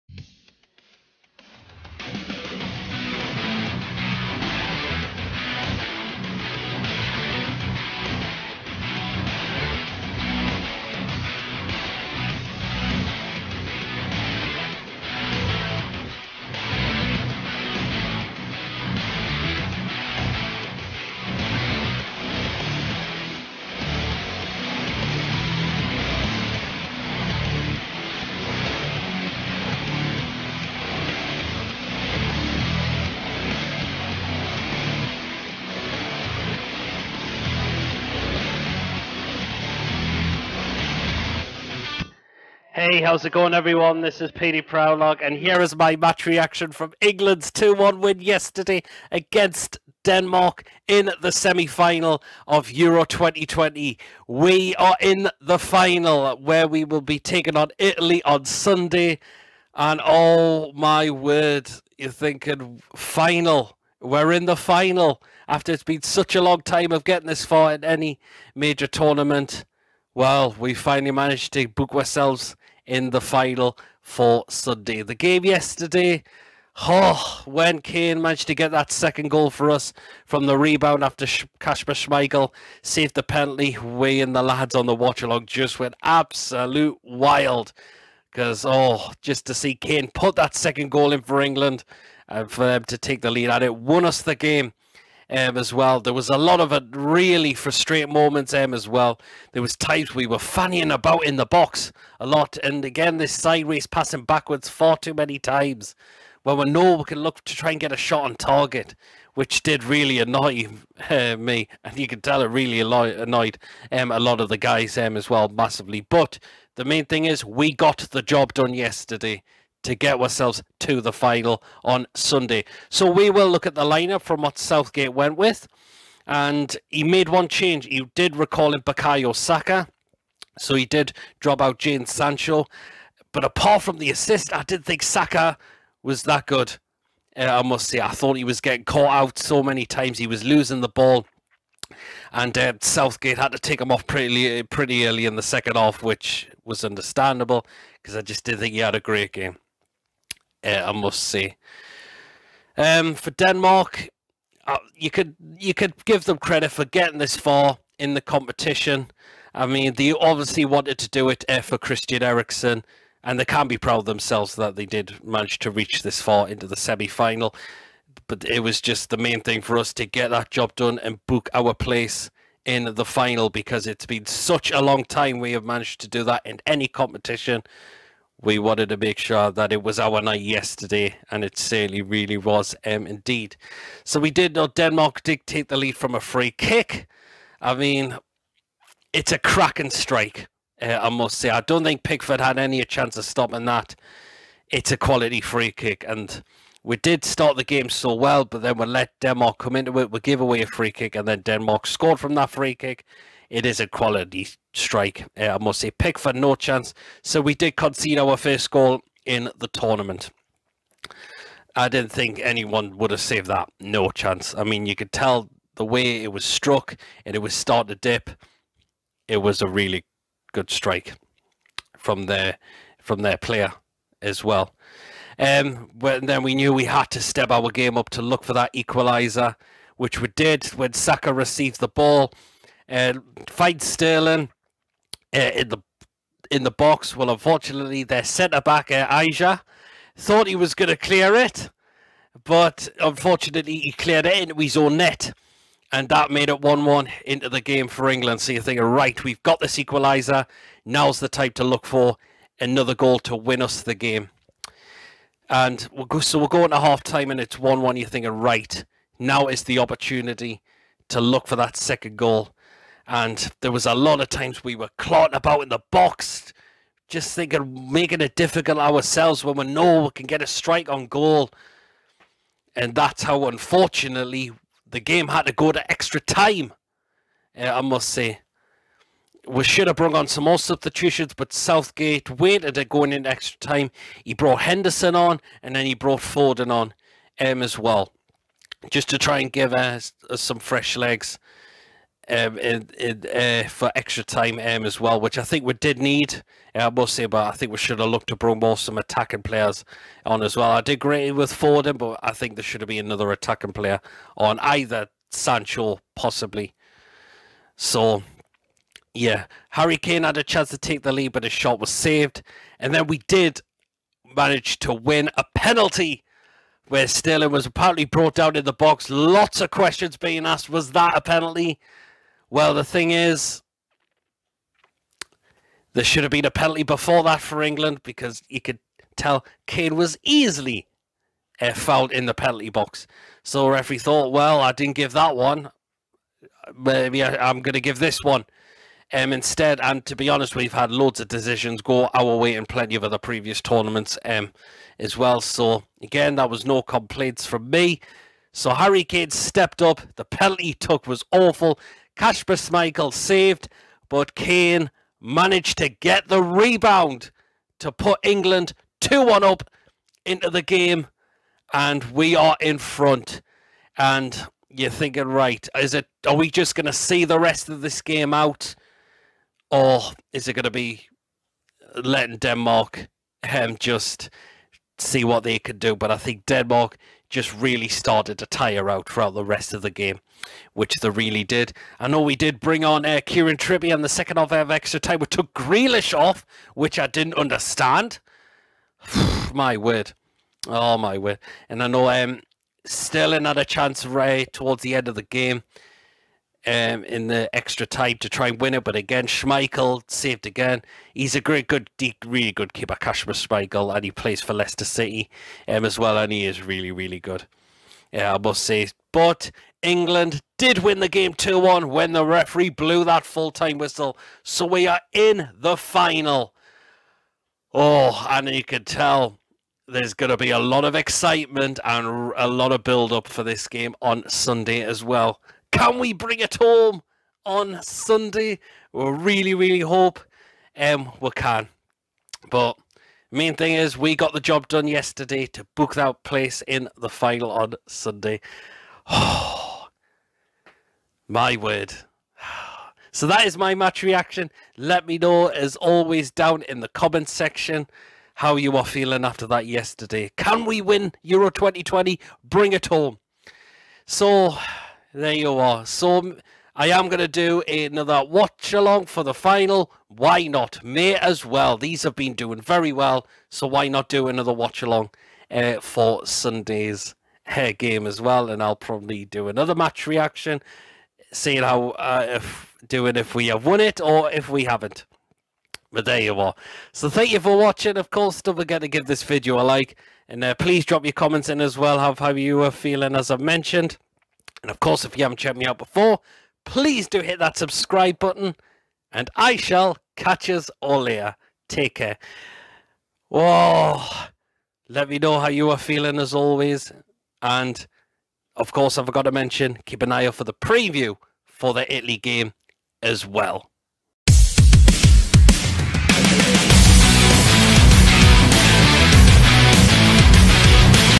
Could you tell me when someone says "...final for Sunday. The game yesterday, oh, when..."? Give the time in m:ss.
1:13.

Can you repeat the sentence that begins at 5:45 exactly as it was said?
So again, that was no complaints from me.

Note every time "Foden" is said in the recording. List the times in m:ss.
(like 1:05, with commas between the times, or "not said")
4:46, 5:01.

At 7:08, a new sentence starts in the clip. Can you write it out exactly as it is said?
We really, really hope um, we can.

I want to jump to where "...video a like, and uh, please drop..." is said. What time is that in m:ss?
7:59.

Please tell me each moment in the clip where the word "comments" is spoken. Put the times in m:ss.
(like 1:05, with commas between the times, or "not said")
7:26, 8:01.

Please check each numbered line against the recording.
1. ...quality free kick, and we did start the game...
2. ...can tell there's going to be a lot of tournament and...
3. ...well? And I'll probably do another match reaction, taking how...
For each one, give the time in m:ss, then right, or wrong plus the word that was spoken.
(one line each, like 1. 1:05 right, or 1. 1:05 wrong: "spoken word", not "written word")
1. 3:14 right
2. 6:58 wrong: "excitement", not "tournament"
3. 7:48 wrong: "seeing", not "taking".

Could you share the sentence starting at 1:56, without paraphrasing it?
But the main thing is we got the job done yesterday to get ourselves to the final on Sunday.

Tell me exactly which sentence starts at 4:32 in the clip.
And that's how, unfortunately, the game had to go to extra time, uh, I must say.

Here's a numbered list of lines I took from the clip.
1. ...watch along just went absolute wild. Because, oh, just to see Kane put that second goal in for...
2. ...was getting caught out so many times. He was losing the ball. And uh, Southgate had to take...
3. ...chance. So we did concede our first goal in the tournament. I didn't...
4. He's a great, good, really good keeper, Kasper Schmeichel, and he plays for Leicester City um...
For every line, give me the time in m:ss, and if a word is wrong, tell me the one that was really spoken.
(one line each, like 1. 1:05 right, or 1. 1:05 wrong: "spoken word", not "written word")
1. 1:24 right
2. 2:18 right
3. 3:26 right
4. 6:41 right.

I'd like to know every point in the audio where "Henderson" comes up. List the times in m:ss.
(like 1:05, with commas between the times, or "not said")
4:44.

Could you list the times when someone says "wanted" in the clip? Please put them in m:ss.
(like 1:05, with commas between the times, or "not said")
2:40, 2:58.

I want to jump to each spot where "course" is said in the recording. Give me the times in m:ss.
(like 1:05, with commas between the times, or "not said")
7:58, 8:04, 8:18.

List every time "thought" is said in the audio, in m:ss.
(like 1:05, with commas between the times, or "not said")
2:18, 4:00, 5:33.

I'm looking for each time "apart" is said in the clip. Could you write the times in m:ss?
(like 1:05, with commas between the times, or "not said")
2:13.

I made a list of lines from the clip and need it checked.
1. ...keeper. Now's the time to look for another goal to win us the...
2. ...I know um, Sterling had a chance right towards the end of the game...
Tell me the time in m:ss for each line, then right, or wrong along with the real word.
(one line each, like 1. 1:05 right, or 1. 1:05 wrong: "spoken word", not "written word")
1. 4:09 wrong: "equaliser", not "keeper"
2. 6:31 right.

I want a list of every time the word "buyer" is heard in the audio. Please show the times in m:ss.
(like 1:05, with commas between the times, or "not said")
not said.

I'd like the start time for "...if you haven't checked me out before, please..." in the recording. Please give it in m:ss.
8:05.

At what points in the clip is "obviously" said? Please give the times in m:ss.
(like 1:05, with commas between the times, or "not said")
2:40.